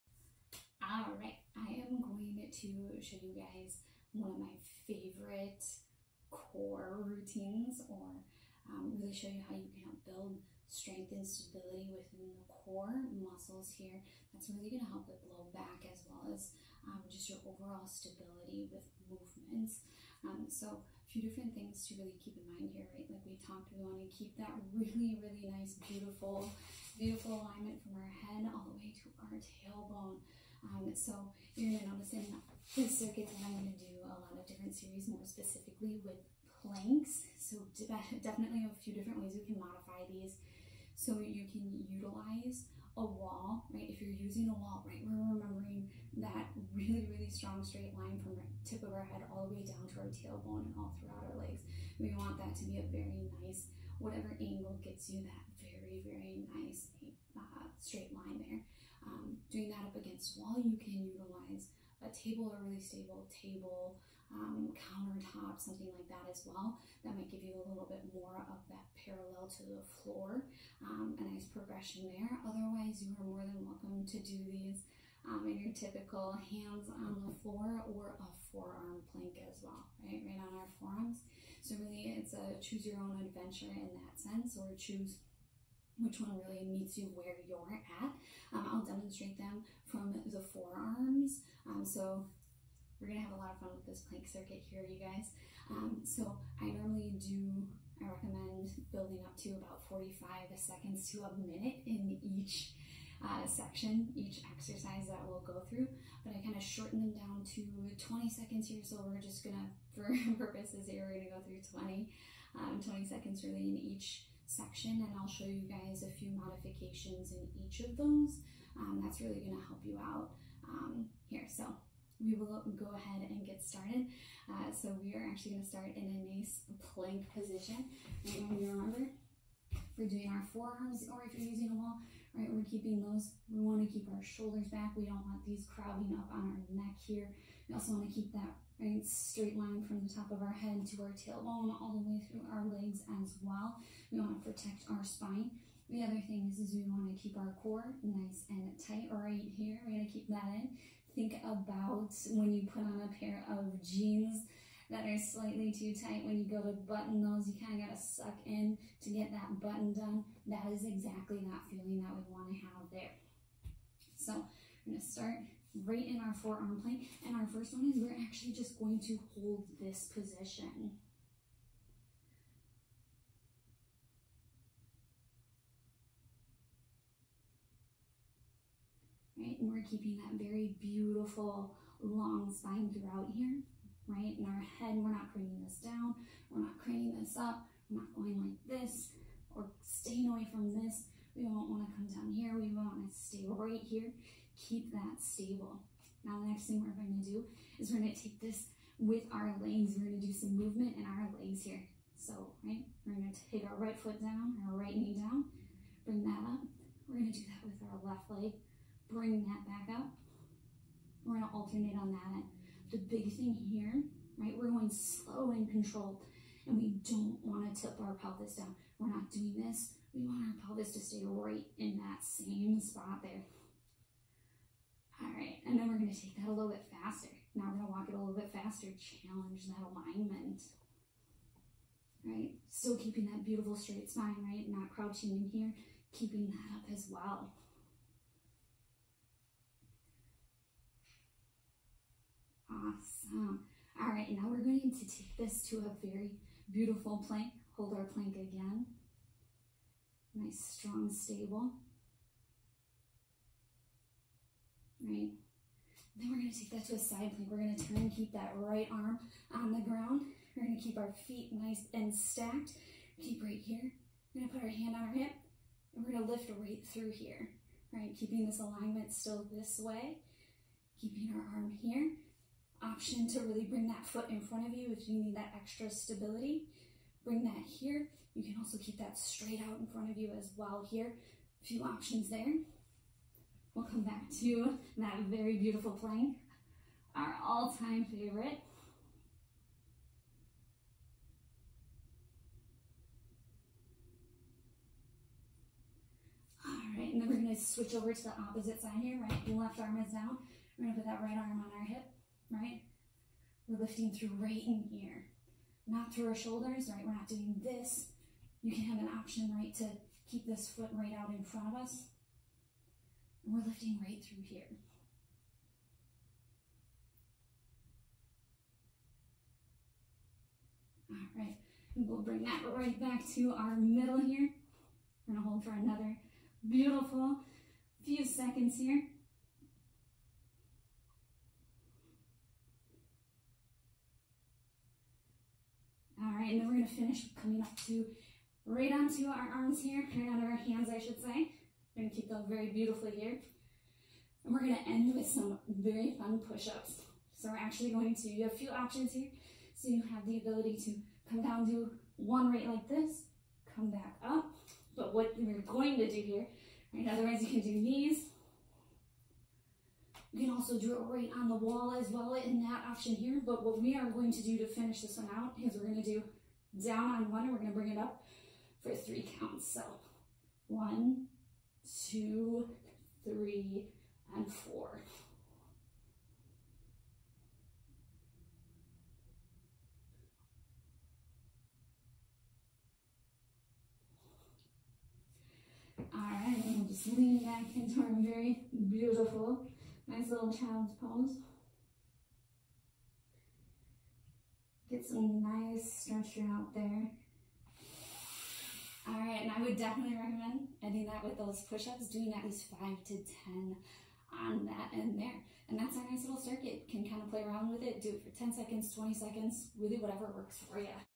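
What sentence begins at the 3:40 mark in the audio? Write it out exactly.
We want our pelvis to stay right in that same spot there.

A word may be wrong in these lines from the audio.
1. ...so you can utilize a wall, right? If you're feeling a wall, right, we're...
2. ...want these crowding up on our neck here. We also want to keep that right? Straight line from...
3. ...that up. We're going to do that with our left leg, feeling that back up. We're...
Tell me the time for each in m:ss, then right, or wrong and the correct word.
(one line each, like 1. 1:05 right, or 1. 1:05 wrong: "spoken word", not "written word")
1. 0:40 wrong: "using", not "feeling"
2. 2:15 right
3. 3:26 wrong: "bring", not "feeling".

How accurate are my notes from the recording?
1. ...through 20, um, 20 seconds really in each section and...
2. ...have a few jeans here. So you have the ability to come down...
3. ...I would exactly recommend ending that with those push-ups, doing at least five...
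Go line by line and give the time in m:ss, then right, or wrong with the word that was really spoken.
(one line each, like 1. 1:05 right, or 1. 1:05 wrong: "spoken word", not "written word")
1. 1:51 right
2. 5:48 wrong: "options", not "jeans"
3. 6:39 wrong: "definitely", not "exactly".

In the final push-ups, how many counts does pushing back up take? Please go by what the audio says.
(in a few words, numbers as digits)
3.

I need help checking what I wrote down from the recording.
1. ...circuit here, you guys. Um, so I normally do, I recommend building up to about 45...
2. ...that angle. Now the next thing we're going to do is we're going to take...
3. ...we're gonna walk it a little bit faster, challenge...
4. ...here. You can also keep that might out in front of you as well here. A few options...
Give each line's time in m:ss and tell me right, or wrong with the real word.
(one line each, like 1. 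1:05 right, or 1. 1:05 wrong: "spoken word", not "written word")
1. 1:34 right
2. 3:14 wrong: "stable", not "angle"
3. 3:47 right
4. 4:37 wrong: "straight", not "might".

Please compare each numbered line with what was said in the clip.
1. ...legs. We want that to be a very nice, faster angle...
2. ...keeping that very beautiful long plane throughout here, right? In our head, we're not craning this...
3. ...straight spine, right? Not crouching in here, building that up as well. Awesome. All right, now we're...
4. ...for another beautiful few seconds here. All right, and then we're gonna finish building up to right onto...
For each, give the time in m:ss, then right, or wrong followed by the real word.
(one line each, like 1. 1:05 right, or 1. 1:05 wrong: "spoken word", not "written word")
1. 0:51 wrong: "whatever", not "faster"
2. 2:59 wrong: "spine", not "plane"
3. 3:53 wrong: "keeping", not "building"
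4. 5:25 wrong: "coming", not "building".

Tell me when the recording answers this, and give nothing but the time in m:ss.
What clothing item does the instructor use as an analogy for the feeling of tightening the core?
2:33.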